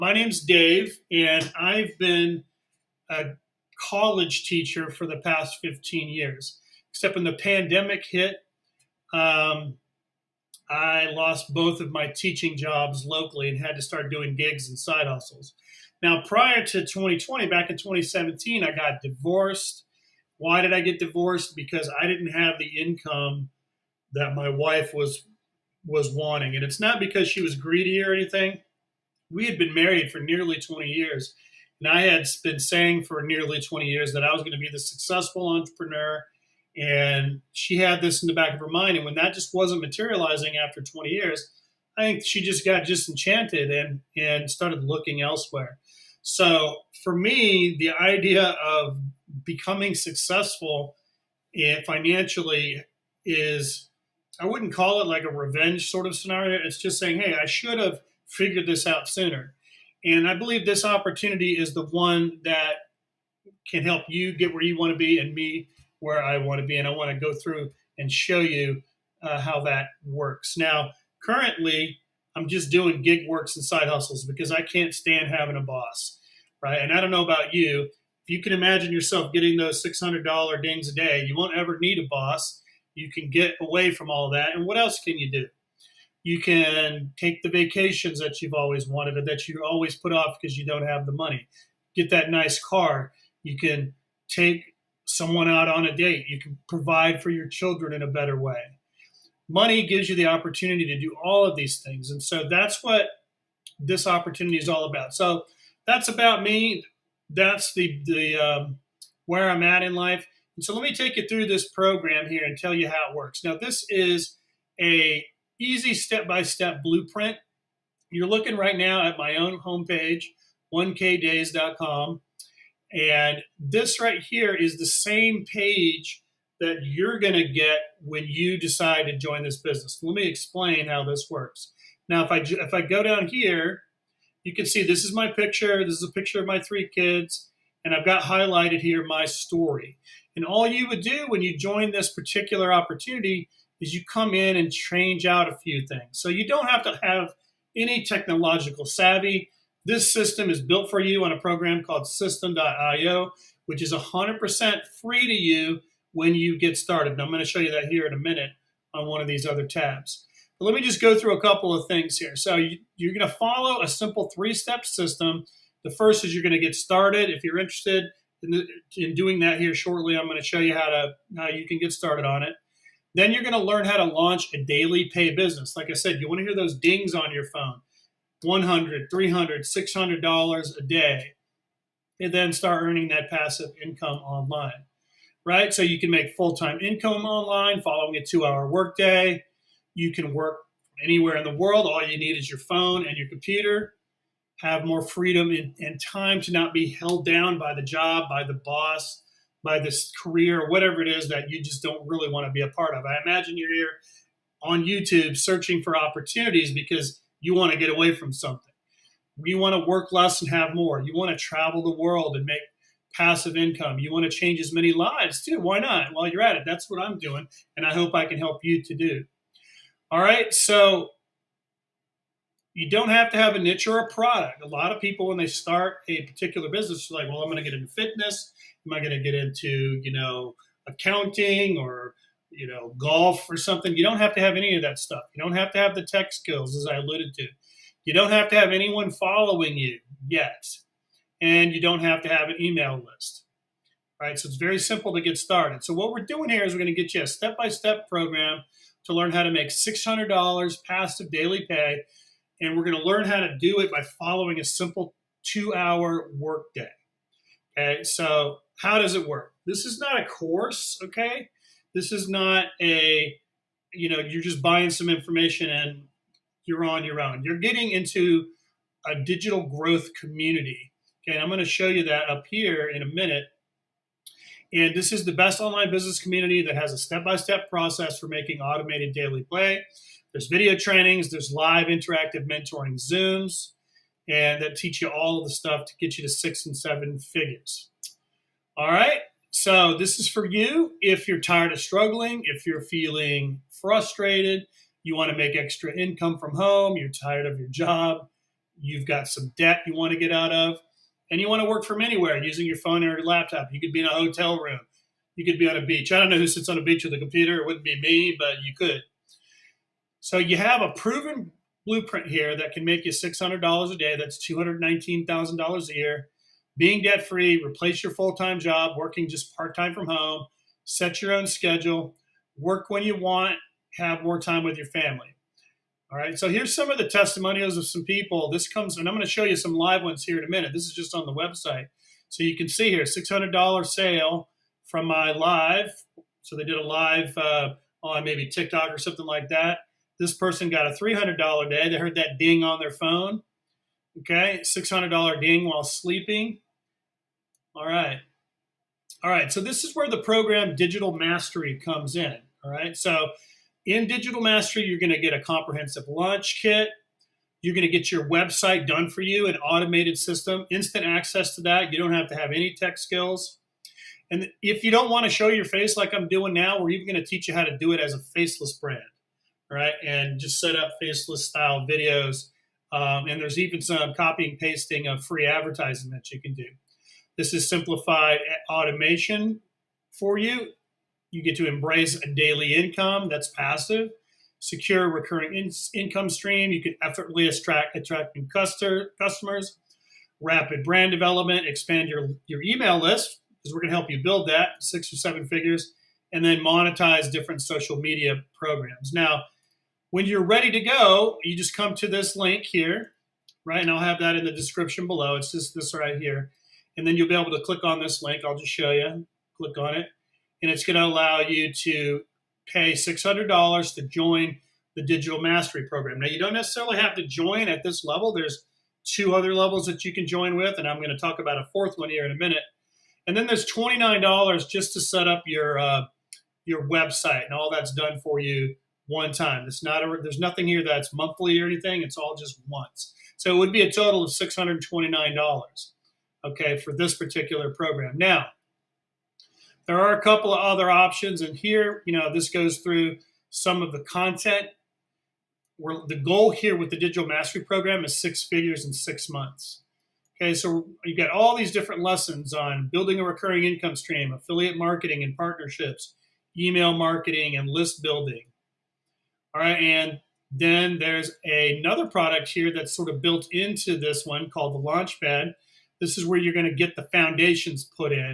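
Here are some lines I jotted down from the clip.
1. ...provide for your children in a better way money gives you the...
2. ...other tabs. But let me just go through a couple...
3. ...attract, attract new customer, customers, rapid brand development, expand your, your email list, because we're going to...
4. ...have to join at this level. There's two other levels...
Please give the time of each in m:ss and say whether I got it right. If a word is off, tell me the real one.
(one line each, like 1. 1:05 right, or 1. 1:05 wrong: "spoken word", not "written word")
1. 1:36 right
2. 2:39 right
3. 6:27 right
4. 6:56 right.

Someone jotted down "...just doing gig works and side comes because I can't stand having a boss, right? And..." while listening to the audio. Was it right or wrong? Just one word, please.
wrong.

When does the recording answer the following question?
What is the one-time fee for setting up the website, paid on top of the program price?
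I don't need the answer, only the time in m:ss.
7:03.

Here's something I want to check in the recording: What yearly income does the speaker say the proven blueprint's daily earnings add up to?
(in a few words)
$219,000.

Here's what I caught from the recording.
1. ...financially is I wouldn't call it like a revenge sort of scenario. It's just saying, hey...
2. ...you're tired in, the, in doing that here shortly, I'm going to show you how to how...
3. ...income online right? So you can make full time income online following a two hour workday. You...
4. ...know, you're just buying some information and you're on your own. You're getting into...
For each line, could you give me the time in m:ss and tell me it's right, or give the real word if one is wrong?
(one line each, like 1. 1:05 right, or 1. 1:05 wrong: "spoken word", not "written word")
1. 0:51 right
2. 2:47 wrong: "interested", not "tired"
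3. 3:03 right
4. 4:24 right.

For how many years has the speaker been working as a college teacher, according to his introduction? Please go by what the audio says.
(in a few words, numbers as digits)
15 years.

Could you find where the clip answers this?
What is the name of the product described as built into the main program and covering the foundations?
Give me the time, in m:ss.
7:44.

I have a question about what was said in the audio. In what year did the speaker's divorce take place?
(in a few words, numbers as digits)
2017.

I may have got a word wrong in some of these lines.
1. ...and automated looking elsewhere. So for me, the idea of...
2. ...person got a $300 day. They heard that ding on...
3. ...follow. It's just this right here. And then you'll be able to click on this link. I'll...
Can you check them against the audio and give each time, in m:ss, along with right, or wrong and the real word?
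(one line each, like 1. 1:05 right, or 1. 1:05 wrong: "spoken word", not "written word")
1. 0:44 wrong: "started", not "automated"
2. 5:40 right
3. 6:45 wrong: "below", not "follow".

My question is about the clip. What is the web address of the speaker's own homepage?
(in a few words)
1kdays.com.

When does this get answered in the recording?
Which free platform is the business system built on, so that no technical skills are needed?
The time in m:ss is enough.
2:32.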